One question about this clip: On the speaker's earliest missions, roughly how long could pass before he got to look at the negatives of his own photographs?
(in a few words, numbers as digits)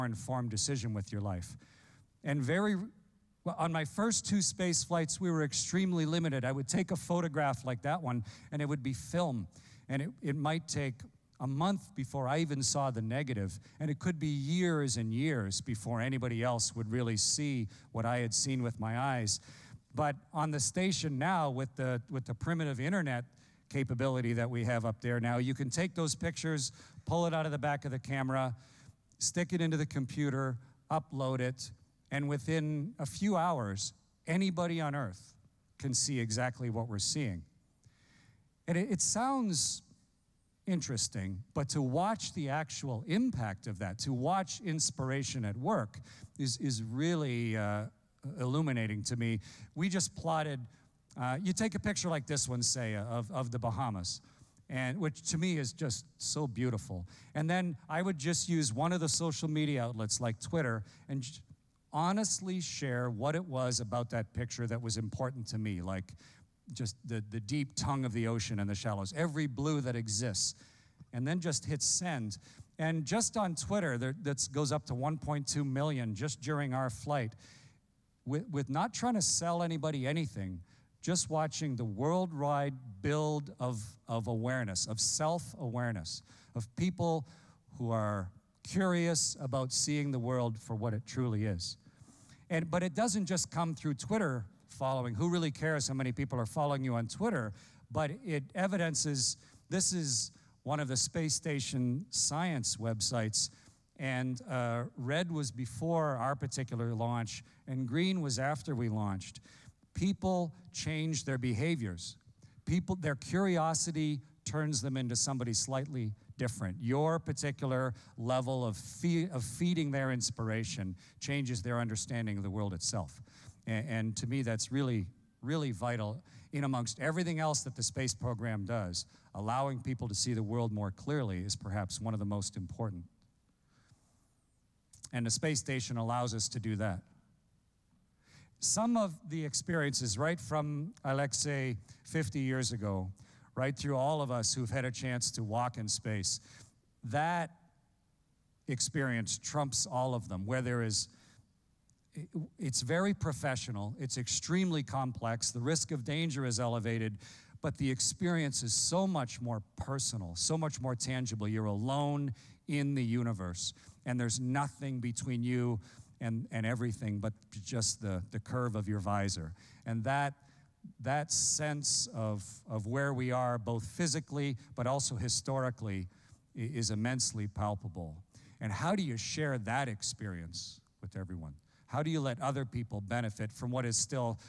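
a month.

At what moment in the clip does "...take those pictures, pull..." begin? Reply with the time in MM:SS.
00:25.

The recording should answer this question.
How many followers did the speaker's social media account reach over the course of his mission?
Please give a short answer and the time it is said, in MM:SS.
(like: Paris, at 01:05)
1.2 million, at 01:14.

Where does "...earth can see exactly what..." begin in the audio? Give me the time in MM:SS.
00:34.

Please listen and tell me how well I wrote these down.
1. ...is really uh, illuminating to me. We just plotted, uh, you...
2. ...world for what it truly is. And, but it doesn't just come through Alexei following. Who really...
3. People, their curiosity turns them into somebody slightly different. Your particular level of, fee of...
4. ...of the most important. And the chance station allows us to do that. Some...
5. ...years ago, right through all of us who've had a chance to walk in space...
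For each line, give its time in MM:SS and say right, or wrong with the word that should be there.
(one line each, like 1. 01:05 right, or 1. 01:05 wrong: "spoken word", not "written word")
1. 00:46 right
2. 01:30 wrong: "Twitter", not "Alexei"
3. 01:52 right
4. 02:12 wrong: "space", not "chance"
5. 02:22 right.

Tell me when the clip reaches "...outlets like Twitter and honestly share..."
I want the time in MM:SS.
00:59.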